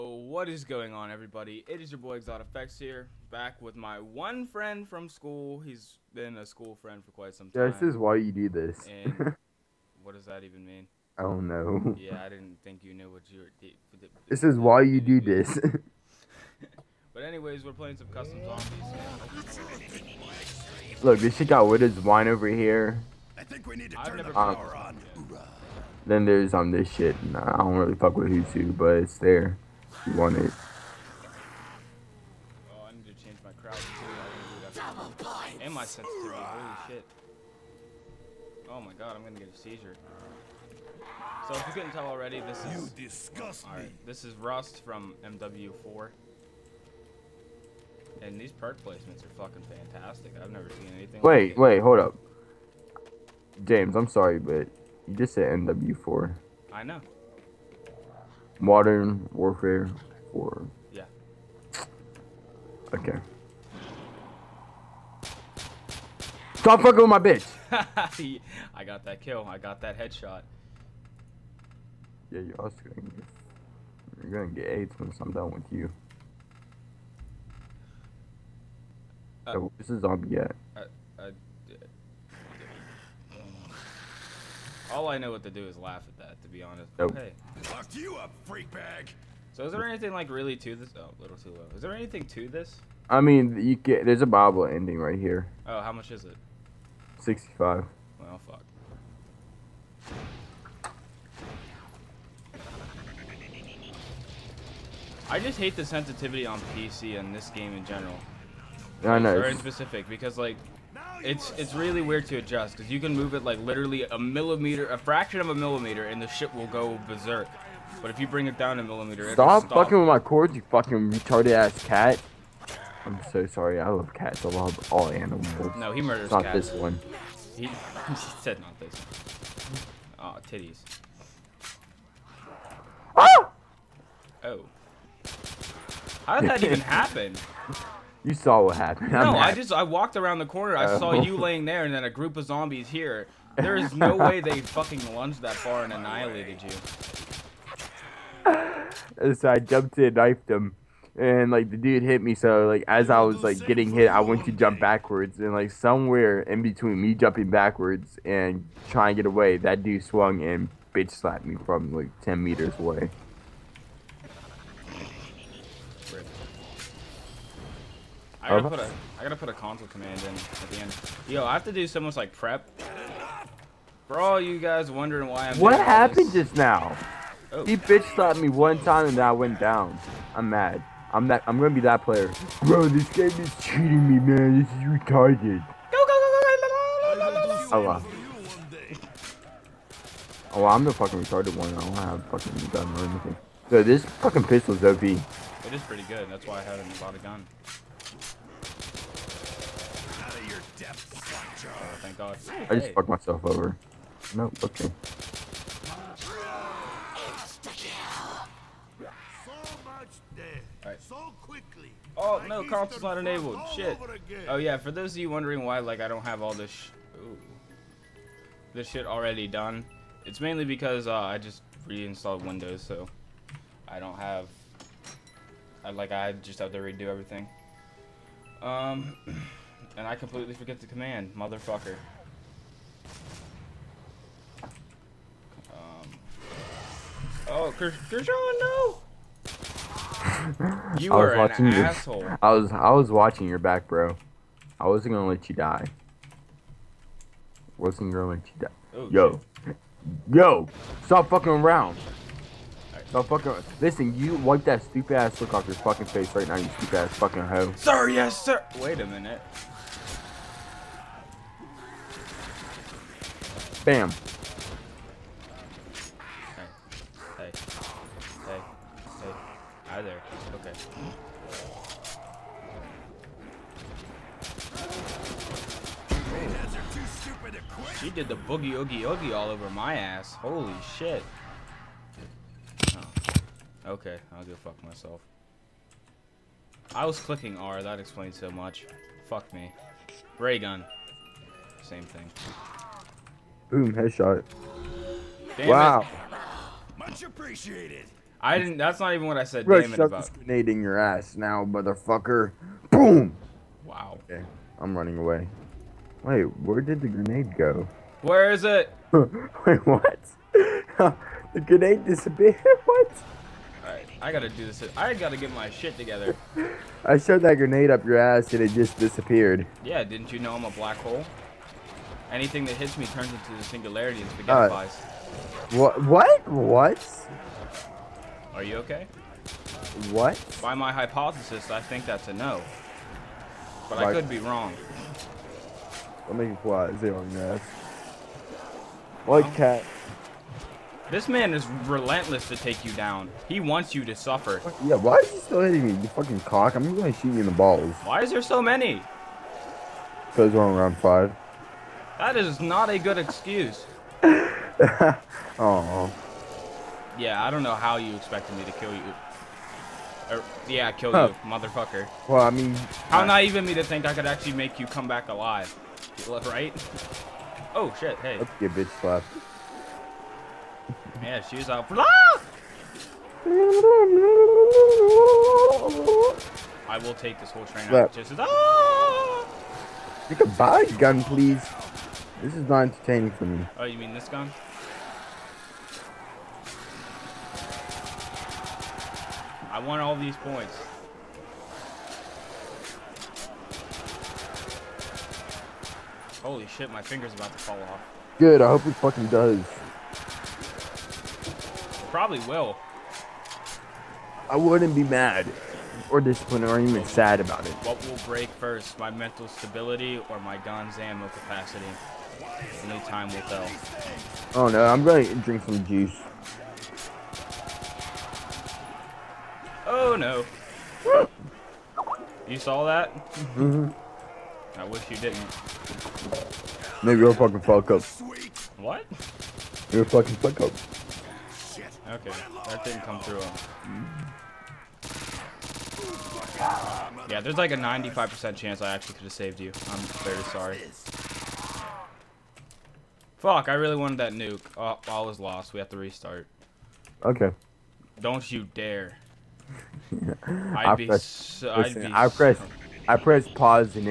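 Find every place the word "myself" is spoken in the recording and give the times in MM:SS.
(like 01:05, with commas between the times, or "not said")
03:23, 04:44.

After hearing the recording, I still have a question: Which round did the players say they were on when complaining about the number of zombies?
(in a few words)
5.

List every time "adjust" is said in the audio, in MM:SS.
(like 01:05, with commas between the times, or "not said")
01:52.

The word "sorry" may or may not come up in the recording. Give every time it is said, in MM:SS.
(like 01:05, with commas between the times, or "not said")
00:54, 02:03, 07:20.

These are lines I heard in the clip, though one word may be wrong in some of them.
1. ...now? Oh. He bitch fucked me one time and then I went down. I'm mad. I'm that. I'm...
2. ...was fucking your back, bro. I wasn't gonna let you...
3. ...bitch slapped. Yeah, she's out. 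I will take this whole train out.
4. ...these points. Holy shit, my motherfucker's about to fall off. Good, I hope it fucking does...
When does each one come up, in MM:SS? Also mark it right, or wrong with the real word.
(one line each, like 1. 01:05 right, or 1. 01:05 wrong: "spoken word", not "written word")
1. 02:56 wrong: "slapped", not "fucked"
2. 04:02 wrong: "watching", not "fucking"
3. 06:08 right
4. 06:30 wrong: "finger", not "motherfucker".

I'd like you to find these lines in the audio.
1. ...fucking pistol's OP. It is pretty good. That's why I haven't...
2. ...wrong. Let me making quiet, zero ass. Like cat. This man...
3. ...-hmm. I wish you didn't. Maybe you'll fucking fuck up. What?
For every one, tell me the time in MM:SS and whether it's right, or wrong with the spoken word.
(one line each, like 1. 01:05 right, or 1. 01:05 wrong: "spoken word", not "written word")
1. 03:14 right
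2. 05:34 right
3. 07:03 right.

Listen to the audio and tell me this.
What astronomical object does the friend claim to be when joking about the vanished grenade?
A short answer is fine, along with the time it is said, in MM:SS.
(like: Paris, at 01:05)
A black hole, at 05:20.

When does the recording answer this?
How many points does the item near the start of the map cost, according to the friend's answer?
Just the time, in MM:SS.
01:37.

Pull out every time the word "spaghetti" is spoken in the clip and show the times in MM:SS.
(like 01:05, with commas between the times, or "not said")
05:24.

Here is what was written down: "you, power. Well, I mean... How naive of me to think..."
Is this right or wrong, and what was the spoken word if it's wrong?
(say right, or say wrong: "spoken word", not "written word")
wrong: "motherfucker", not "power".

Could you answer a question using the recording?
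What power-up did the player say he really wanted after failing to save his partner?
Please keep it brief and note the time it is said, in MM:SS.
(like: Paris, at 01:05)
Nuke, at 07:24.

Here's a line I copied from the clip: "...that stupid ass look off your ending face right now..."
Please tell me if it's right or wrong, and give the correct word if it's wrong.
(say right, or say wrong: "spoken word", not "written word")
wrong: "fucking", not "ending".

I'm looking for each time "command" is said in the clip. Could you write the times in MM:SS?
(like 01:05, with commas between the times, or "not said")
02:49, 03:50.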